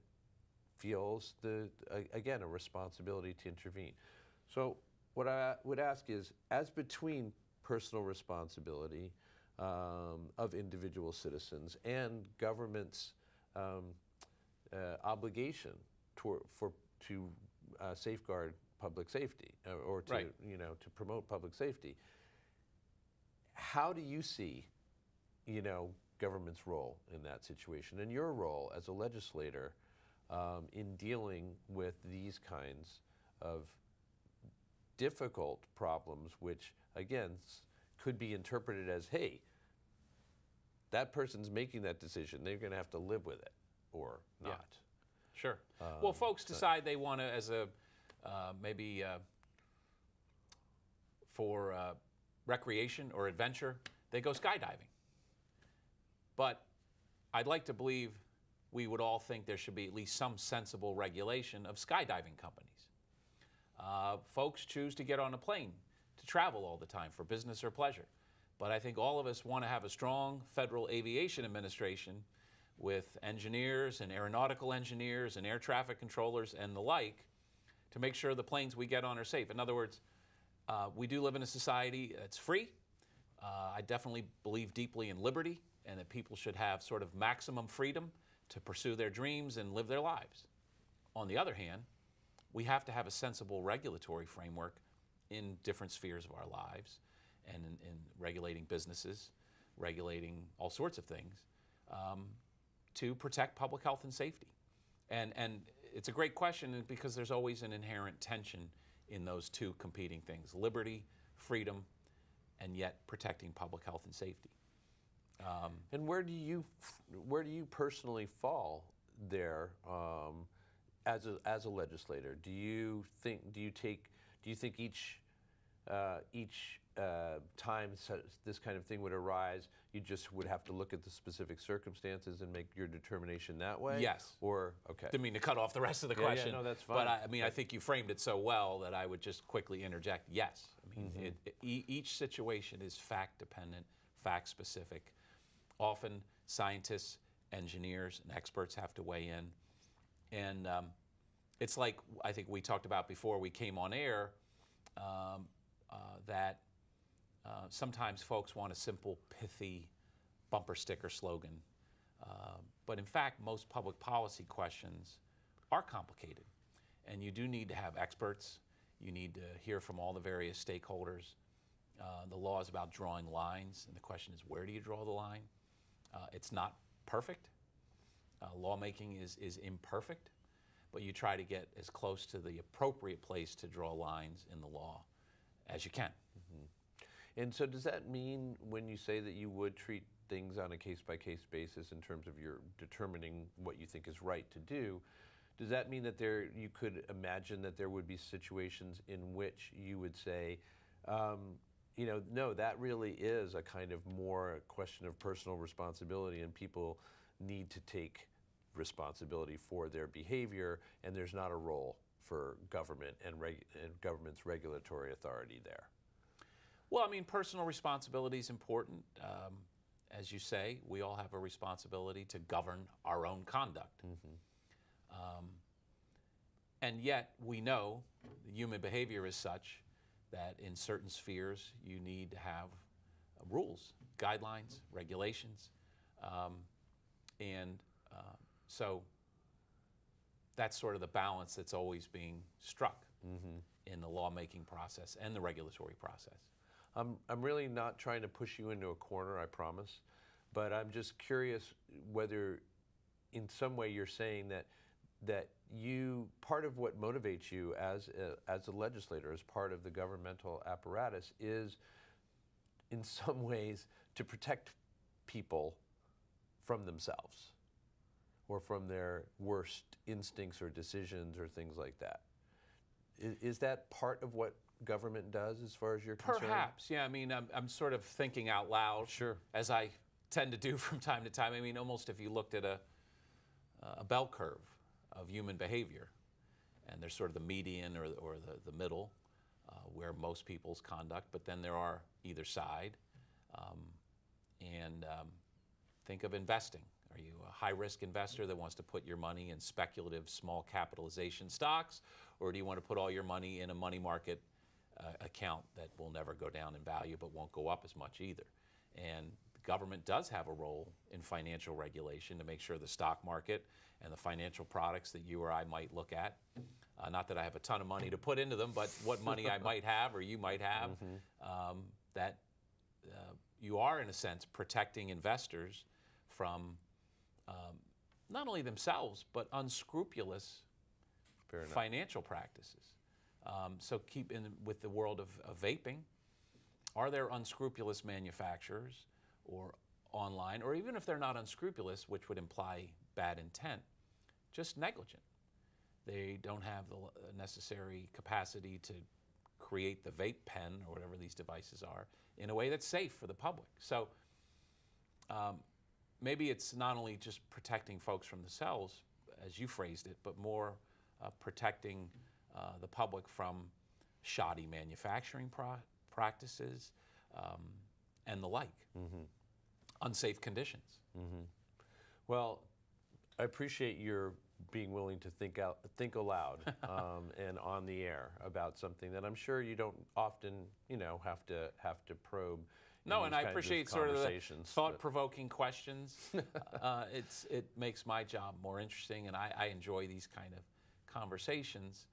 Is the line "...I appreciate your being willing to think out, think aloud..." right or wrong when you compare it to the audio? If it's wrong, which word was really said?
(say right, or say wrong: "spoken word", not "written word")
right.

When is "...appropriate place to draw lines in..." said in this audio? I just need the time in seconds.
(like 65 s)
182 s.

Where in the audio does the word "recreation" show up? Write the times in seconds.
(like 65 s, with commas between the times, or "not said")
52 s.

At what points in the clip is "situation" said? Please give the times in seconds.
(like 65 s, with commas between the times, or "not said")
27 s, 142 s, 198 s.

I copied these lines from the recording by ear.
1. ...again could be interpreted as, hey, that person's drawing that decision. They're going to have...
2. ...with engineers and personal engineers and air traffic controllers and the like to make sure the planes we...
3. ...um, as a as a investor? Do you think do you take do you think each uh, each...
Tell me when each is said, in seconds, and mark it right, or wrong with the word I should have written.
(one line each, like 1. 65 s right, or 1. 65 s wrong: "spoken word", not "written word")
1. 36 s wrong: "making", not "drawing"
2. 72 s wrong: "aeronautical", not "personal"
3. 119 s wrong: "legislator", not "investor".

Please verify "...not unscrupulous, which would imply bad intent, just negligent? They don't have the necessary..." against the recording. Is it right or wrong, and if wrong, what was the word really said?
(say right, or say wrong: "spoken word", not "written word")
right.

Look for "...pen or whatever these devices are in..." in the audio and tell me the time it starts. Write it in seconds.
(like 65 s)
350 s.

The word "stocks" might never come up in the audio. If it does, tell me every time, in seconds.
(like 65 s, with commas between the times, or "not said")
301 s, 312 s.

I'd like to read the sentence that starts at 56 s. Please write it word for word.
But I'd like to believe we would all think there should be at least some sensible regulation of skydiving companies.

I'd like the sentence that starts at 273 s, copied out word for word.
Is, is that part of what government does as far as you're concerned?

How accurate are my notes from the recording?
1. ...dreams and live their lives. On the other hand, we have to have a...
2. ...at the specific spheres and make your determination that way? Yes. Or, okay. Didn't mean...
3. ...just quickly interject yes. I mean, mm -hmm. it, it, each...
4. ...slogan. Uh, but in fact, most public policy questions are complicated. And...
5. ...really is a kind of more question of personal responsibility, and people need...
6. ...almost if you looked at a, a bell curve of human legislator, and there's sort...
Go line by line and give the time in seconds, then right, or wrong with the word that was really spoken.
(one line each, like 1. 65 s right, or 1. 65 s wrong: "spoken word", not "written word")
1. 89 s right
2. 130 s wrong: "circumstances", not "spheres"
3. 139 s right
4. 161 s right
5. 202 s right
6. 281 s wrong: "behavior", not "legislator".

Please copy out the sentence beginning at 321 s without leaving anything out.
um, that uh, you are, in a sense, protecting investors from um, not only themselves, but unscrupulous financial practices.